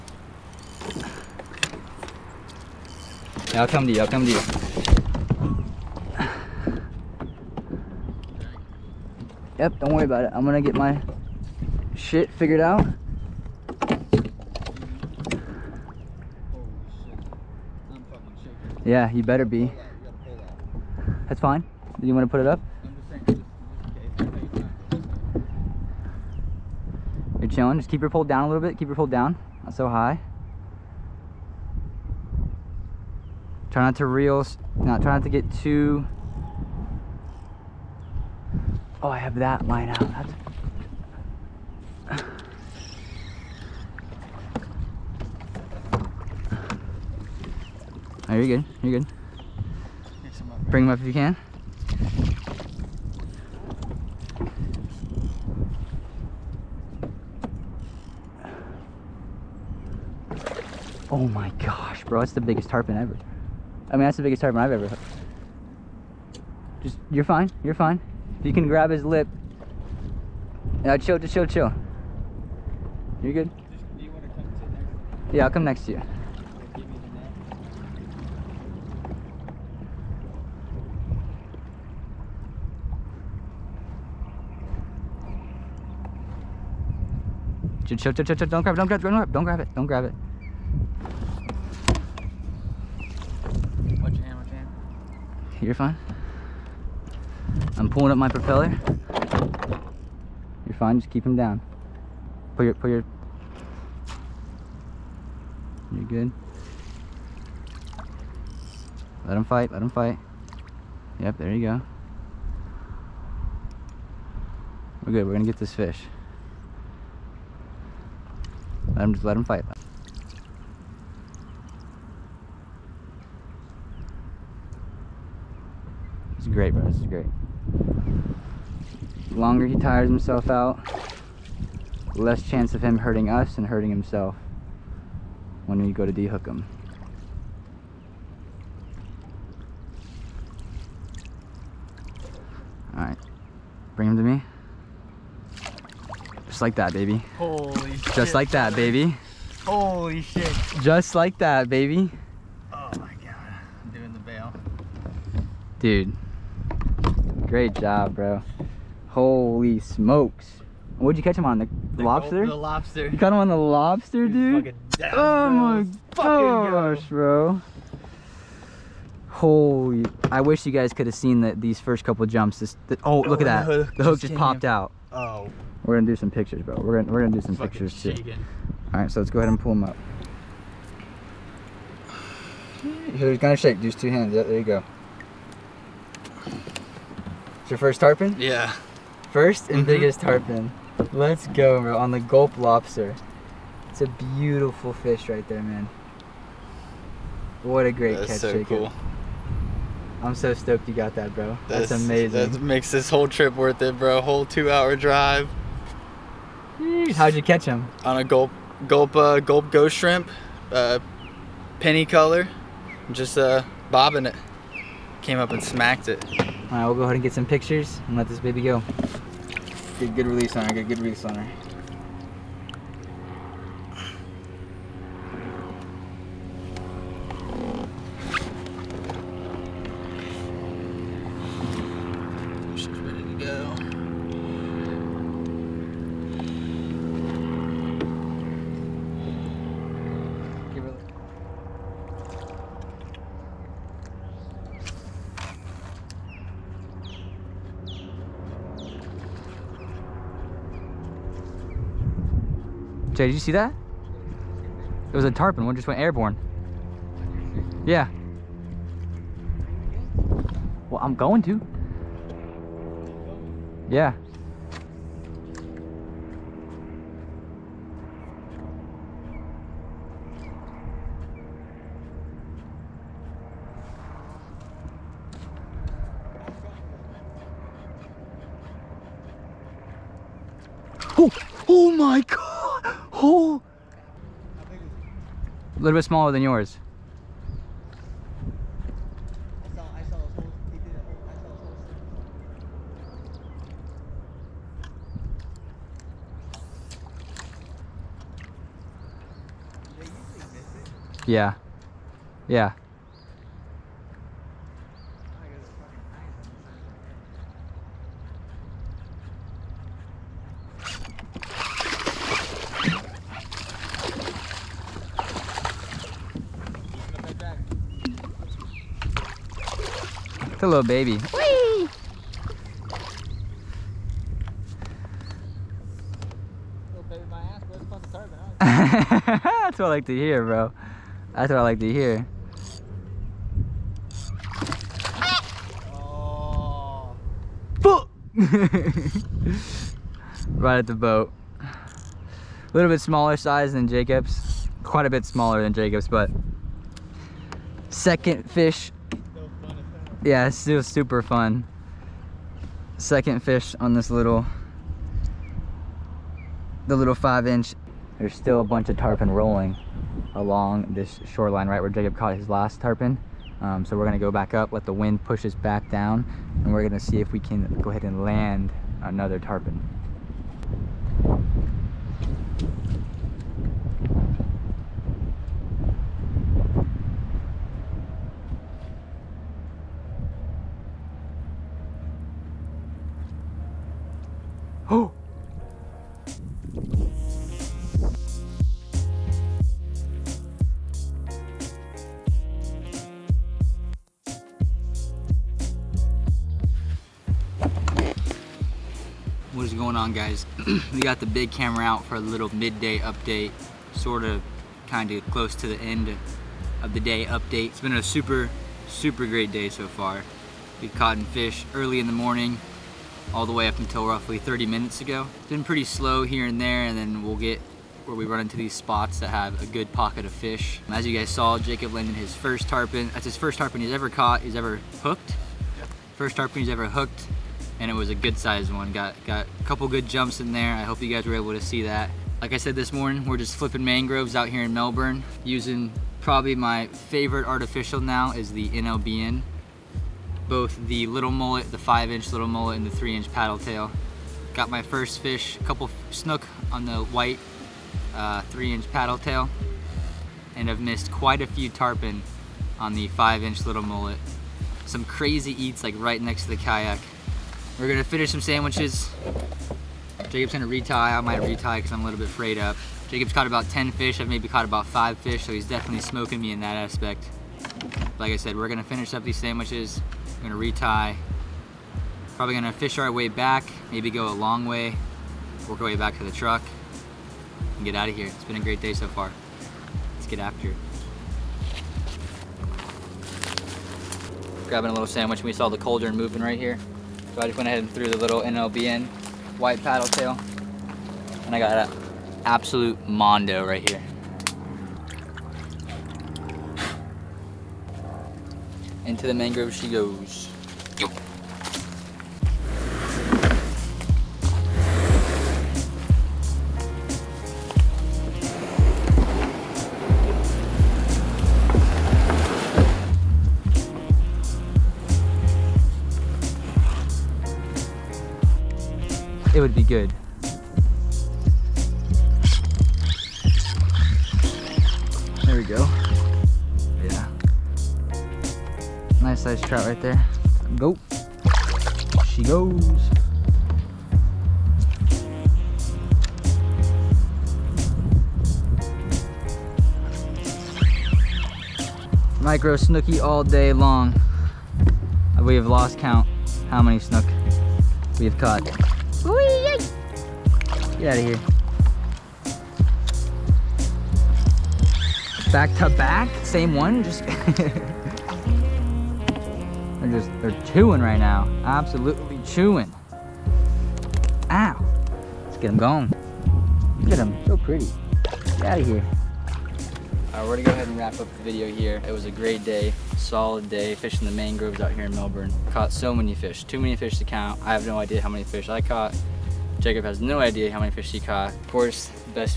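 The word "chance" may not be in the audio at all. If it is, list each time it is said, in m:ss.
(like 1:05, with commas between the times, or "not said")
2:12.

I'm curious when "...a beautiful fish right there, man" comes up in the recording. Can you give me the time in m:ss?
3:14.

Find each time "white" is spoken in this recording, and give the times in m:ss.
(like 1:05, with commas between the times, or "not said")
7:26, 8:09.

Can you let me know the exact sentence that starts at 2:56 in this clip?
We're gonna we're gonna do some Fucking pictures shaking.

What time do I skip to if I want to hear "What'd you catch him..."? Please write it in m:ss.
2:40.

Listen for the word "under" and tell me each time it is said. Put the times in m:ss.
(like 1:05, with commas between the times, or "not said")
not said.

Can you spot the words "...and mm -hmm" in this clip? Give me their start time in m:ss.
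3:09.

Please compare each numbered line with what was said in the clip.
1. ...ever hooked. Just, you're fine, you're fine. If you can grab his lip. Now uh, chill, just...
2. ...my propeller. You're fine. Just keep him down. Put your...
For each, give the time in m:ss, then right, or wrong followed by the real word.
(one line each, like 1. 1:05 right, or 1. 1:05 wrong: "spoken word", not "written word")
1. 1:04 right
2. 1:38 right.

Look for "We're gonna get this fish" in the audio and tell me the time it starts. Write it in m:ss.
1:55.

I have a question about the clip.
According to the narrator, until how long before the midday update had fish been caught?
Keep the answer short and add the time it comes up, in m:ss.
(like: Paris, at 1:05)
30 minutes, at 6:54.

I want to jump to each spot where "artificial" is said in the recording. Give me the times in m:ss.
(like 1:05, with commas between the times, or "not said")
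7:17.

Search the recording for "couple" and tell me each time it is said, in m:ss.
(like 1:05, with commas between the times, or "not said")
2:52, 7:09, 7:25.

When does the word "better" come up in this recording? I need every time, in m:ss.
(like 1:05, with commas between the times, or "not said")
0:19.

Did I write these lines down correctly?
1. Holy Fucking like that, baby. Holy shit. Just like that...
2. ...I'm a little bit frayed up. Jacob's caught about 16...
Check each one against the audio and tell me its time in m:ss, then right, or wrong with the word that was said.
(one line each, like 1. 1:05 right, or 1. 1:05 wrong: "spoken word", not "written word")
1. 2:27 wrong: "Just", not "Fucking"
2. 7:41 wrong: "10", not "16".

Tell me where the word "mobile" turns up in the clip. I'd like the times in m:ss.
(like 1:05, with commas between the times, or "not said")
not said.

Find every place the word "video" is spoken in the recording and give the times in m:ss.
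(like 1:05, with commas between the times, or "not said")
9:31.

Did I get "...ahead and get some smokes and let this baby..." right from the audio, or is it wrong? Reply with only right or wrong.
wrong.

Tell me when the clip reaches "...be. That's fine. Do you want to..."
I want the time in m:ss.
0:19.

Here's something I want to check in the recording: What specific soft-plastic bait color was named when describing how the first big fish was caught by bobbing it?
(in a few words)
penny.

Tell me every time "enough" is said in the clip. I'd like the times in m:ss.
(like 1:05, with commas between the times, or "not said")
not said.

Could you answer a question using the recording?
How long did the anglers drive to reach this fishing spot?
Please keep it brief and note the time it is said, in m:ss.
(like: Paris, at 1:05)
2 hours, at 3:24.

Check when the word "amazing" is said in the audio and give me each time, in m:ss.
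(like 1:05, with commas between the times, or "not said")
3:21.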